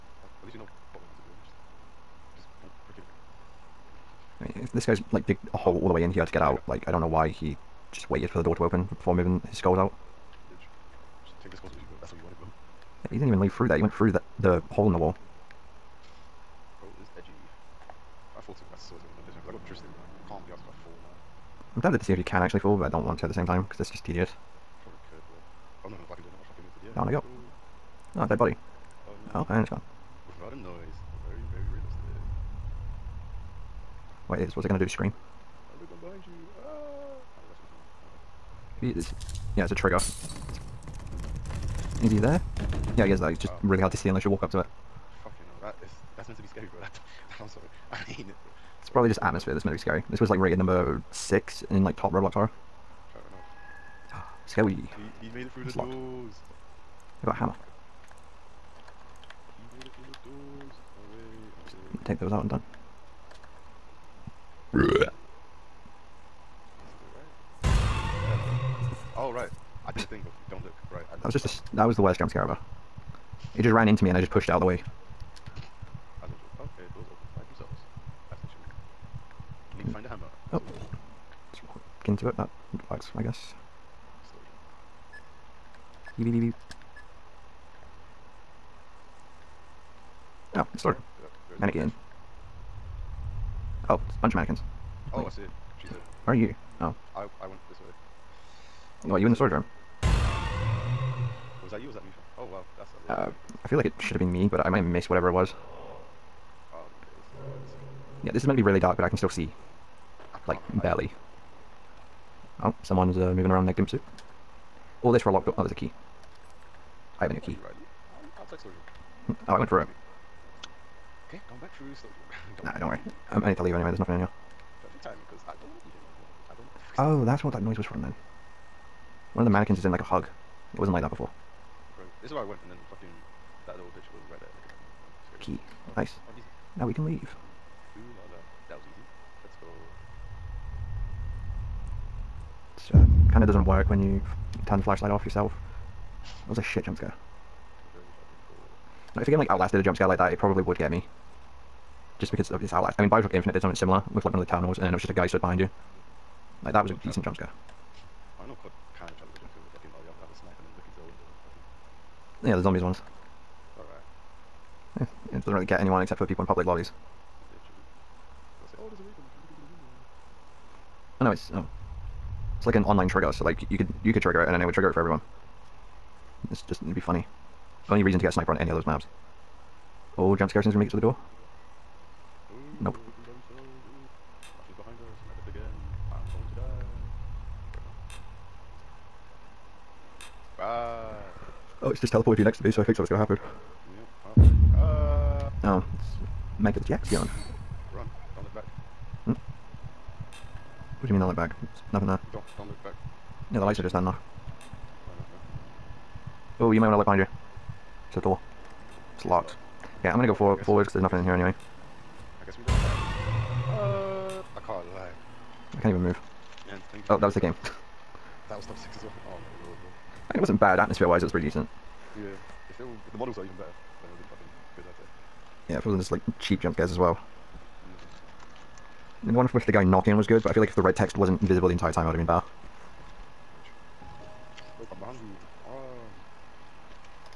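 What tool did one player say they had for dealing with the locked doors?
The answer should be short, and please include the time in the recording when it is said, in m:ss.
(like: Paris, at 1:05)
Hammer, at 0:57.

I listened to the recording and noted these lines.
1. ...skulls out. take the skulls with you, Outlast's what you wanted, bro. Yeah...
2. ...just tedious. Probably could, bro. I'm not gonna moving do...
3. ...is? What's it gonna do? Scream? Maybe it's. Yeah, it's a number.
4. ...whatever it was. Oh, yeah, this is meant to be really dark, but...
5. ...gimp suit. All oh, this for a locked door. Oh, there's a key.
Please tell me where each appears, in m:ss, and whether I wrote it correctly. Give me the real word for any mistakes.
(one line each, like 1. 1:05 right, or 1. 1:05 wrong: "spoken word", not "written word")
1. 0:09 wrong: "That", not "Outlast"
2. 0:23 wrong: "fucking", not "moving"
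3. 0:34 wrong: "trigger", not "number"
4. 1:45 right
5. 1:53 right.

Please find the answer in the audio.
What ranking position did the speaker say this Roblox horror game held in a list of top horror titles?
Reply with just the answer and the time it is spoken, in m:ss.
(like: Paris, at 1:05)
6, at 0:50.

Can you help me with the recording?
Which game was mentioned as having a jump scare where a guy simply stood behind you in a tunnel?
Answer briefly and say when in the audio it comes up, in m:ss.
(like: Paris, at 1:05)
Bioshock Infinite, at 2:33.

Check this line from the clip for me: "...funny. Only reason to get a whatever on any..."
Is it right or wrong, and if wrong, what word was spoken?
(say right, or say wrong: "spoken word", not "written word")
wrong: "sniper", not "whatever".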